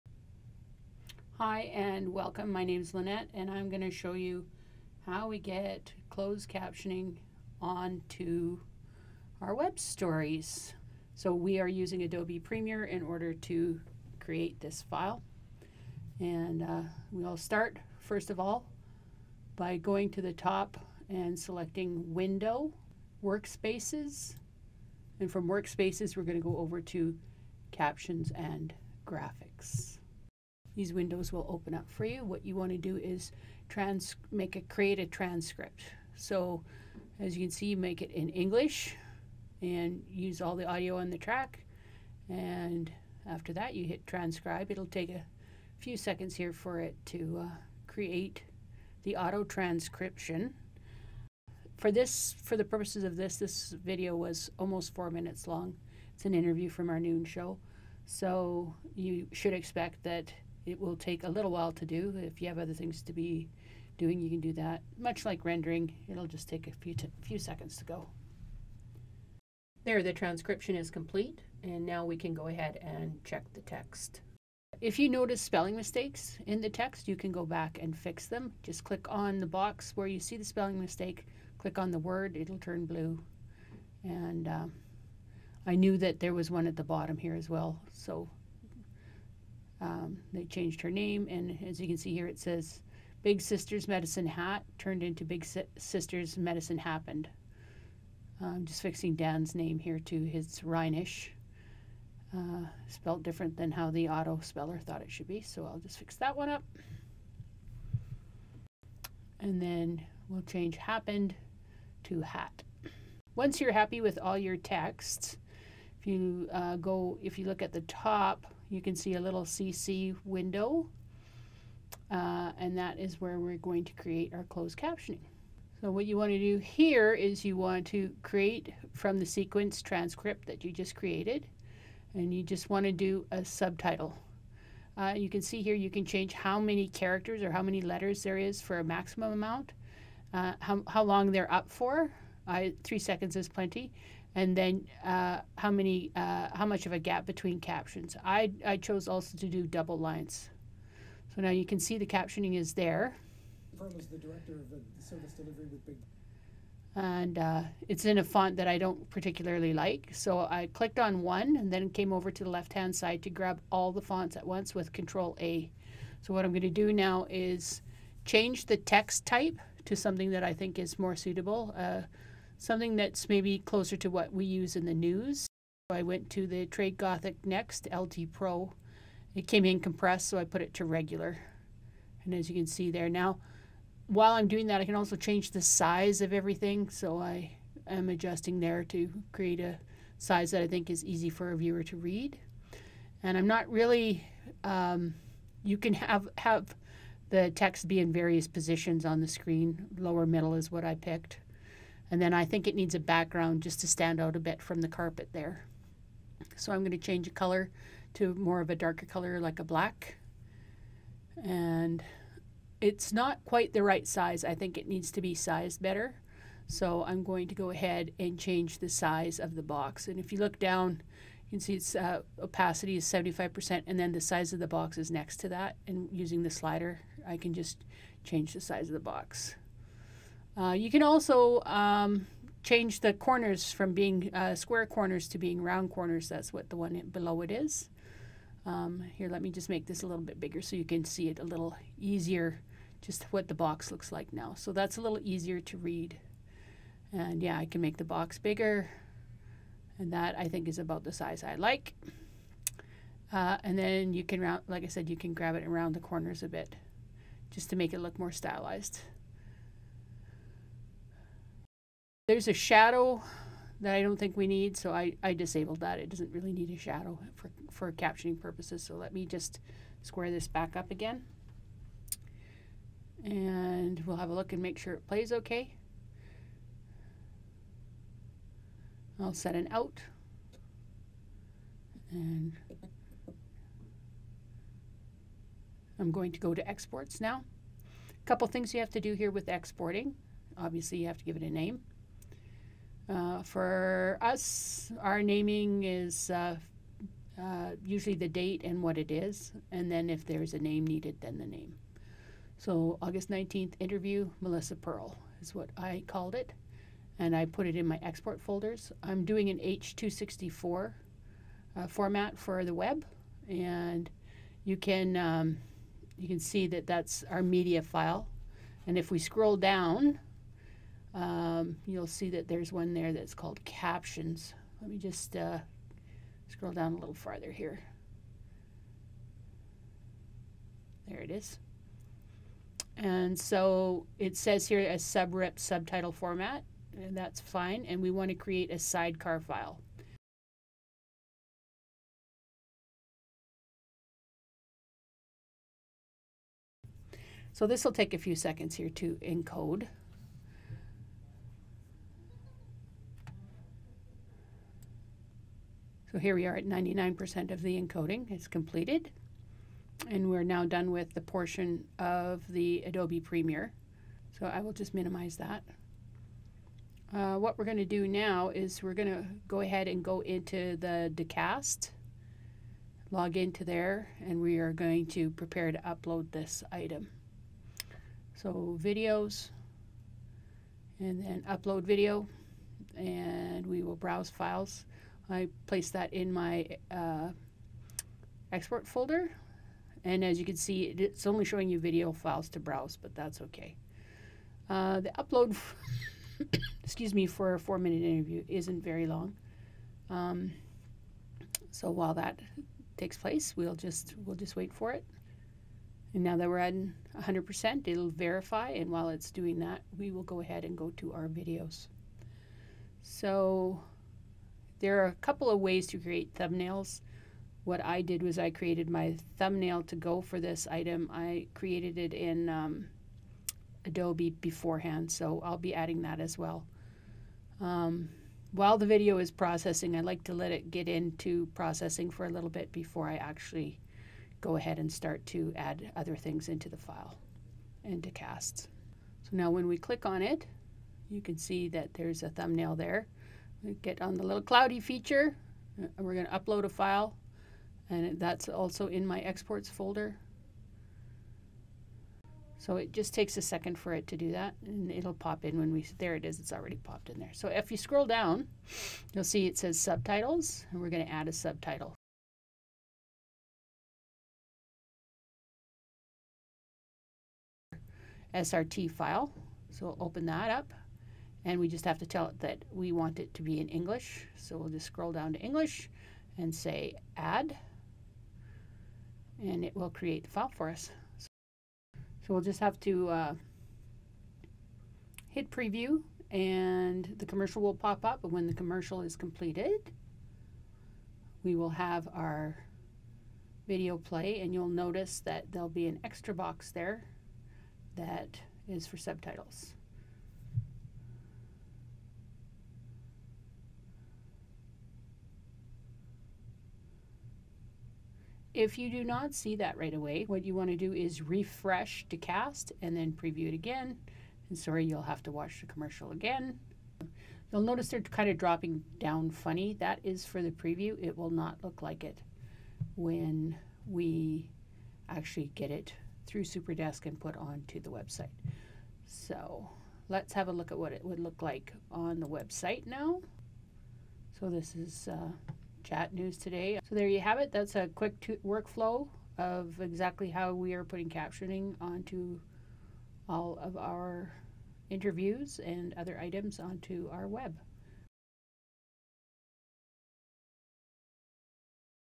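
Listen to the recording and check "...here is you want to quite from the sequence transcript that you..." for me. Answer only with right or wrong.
wrong.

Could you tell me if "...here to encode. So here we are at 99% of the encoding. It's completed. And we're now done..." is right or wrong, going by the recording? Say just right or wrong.
right.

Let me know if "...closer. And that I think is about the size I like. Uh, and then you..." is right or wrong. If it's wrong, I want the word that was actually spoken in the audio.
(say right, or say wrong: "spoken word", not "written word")
wrong: "bigger", not "closer".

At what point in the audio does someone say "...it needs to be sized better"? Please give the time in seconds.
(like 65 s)
214 s.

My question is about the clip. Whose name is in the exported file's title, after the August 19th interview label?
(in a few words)
Melissa Pearl.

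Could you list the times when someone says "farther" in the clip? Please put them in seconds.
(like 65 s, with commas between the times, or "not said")
327 s.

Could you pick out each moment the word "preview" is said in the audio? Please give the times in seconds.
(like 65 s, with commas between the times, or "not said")
485 s, 513 s, 520 s.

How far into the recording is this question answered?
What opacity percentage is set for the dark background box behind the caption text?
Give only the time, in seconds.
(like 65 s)
223 s.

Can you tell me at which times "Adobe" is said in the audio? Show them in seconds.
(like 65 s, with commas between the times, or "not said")
12 s, 362 s, 423 s.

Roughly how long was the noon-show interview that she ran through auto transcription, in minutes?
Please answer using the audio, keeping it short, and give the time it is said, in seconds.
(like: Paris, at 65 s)
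4 minutes, at 54 s.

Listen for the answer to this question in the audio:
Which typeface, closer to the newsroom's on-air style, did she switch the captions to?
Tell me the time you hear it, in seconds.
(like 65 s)
176 s.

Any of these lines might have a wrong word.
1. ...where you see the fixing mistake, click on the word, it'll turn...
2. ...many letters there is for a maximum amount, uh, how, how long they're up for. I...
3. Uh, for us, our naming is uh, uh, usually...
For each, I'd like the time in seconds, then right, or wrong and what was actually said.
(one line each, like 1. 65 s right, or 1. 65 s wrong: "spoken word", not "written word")
1. 79 s wrong: "spelling", not "fixing"
2. 137 s right
3. 293 s right.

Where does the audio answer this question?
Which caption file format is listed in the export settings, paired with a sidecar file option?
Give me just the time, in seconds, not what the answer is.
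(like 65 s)
334 s.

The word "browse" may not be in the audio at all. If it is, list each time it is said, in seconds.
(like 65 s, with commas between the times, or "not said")
383 s, 392 s.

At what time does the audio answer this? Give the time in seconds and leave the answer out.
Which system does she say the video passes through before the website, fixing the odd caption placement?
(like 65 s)
526 s.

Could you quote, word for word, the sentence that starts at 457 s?
So if you scroll down, you'll see it says subtitles, and we're going to add a subtitle.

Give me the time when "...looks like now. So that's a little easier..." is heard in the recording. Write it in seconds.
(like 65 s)
243 s.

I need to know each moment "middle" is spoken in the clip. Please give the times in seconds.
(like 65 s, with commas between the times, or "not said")
200 s.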